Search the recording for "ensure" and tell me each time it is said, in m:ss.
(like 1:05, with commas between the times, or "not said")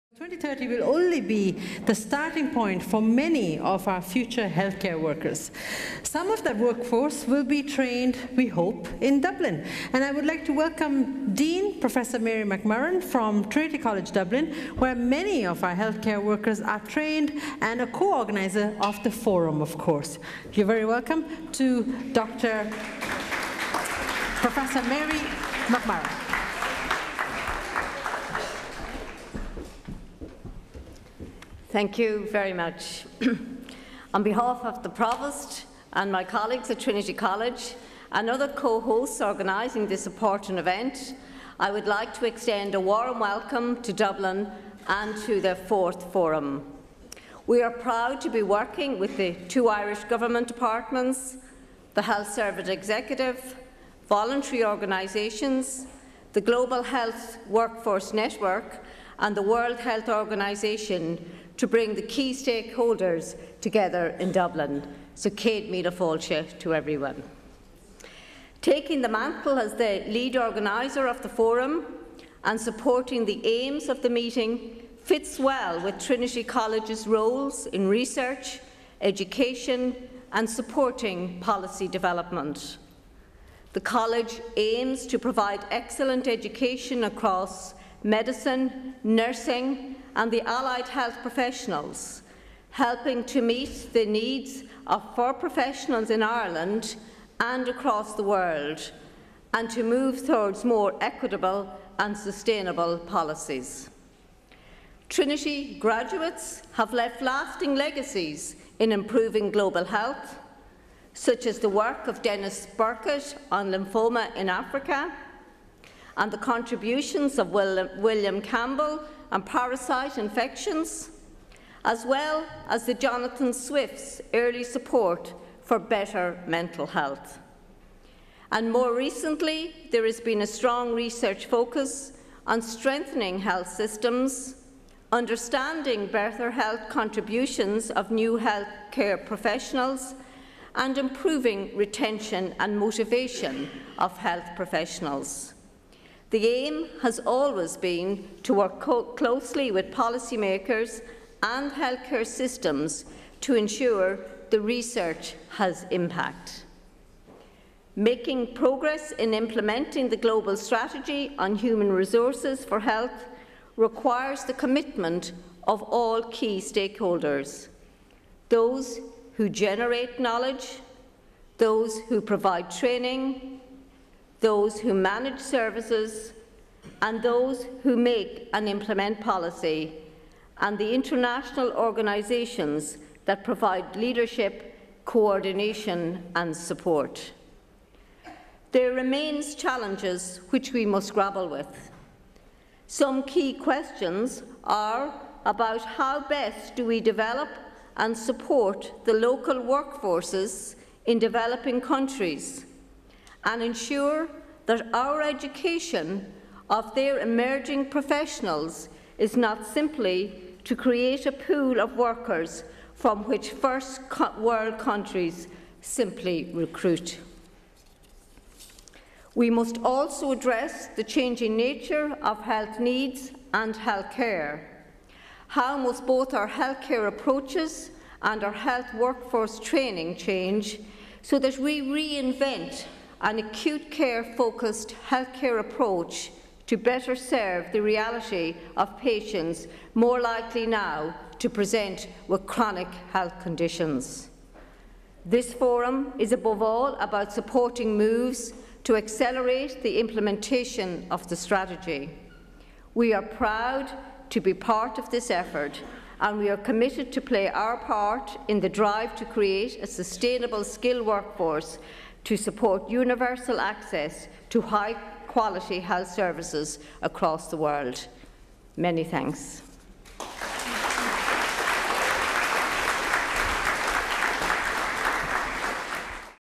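2:33, 3:23.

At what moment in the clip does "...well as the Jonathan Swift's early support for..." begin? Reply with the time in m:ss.
2:02.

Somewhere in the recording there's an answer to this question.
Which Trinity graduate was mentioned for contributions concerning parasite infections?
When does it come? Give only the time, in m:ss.
1:57.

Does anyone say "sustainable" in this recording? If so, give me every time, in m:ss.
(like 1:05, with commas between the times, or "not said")
1:42, 4:19.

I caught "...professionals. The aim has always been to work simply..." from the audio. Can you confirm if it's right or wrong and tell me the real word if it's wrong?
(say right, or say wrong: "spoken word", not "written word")
wrong: "closely", not "simply".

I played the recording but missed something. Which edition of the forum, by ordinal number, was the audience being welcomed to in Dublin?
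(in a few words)
Fourth.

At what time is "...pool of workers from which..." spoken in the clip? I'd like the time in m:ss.
3:31.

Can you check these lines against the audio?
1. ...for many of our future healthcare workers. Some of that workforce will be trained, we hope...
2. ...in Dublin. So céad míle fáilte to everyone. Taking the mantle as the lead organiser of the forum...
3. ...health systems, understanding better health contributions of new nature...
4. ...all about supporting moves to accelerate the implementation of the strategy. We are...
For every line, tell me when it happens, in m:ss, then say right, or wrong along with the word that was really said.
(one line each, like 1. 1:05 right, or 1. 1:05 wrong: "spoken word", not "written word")
1. 0:02 right
2. 1:04 right
3. 2:13 wrong: "healthcare", not "nature"
4. 4:06 right.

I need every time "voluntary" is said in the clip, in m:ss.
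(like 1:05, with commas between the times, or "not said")
0:54.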